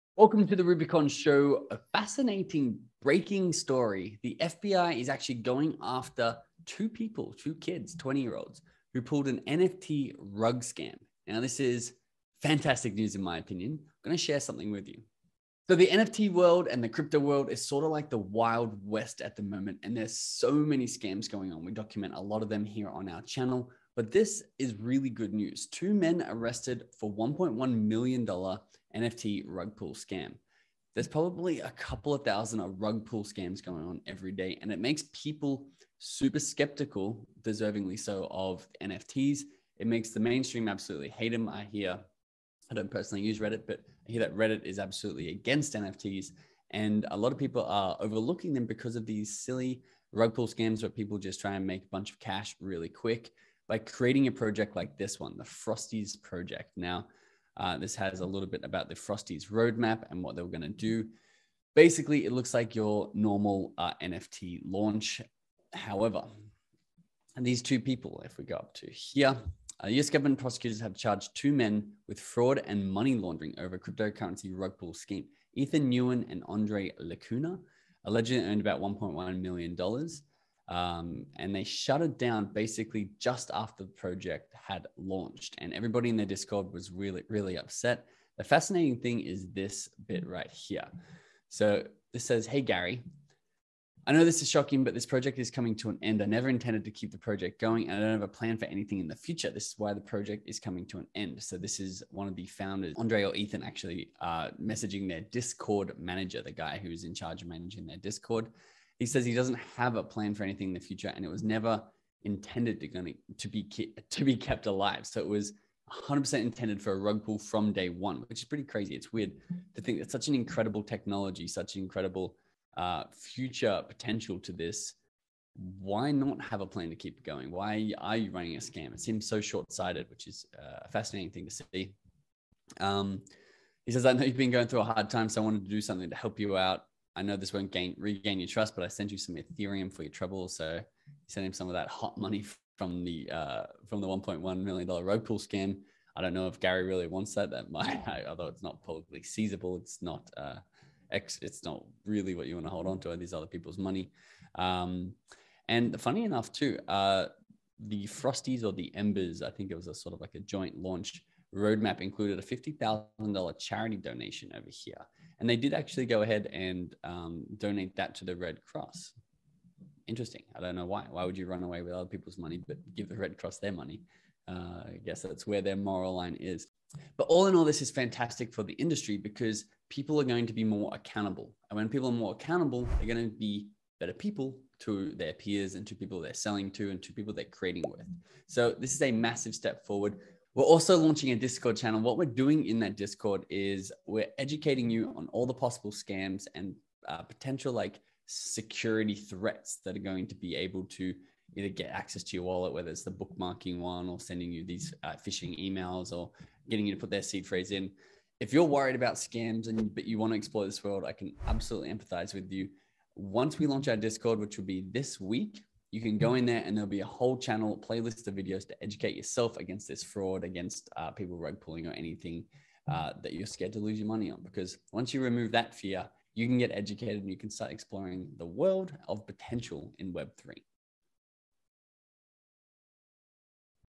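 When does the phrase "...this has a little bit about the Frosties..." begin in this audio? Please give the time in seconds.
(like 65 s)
57 s.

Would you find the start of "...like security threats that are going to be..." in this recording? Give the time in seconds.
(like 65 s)
197 s.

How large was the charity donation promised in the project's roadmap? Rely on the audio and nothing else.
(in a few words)
$50,000.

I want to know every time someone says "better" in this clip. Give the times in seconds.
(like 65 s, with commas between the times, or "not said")
183 s.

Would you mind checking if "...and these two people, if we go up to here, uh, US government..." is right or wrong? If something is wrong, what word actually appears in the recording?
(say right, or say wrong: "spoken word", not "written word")
right.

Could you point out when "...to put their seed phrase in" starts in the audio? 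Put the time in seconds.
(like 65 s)
206 s.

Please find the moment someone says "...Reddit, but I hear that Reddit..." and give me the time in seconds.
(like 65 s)
43 s.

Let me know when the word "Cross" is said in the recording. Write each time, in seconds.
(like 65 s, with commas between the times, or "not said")
168 s, 173 s.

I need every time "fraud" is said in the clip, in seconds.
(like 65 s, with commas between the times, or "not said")
72 s, 220 s.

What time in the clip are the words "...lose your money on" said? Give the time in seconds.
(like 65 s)
223 s.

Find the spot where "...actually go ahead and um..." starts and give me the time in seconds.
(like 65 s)
165 s.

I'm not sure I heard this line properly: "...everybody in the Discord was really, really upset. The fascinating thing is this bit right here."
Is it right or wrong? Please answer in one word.
right.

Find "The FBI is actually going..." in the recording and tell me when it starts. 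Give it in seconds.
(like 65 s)
4 s.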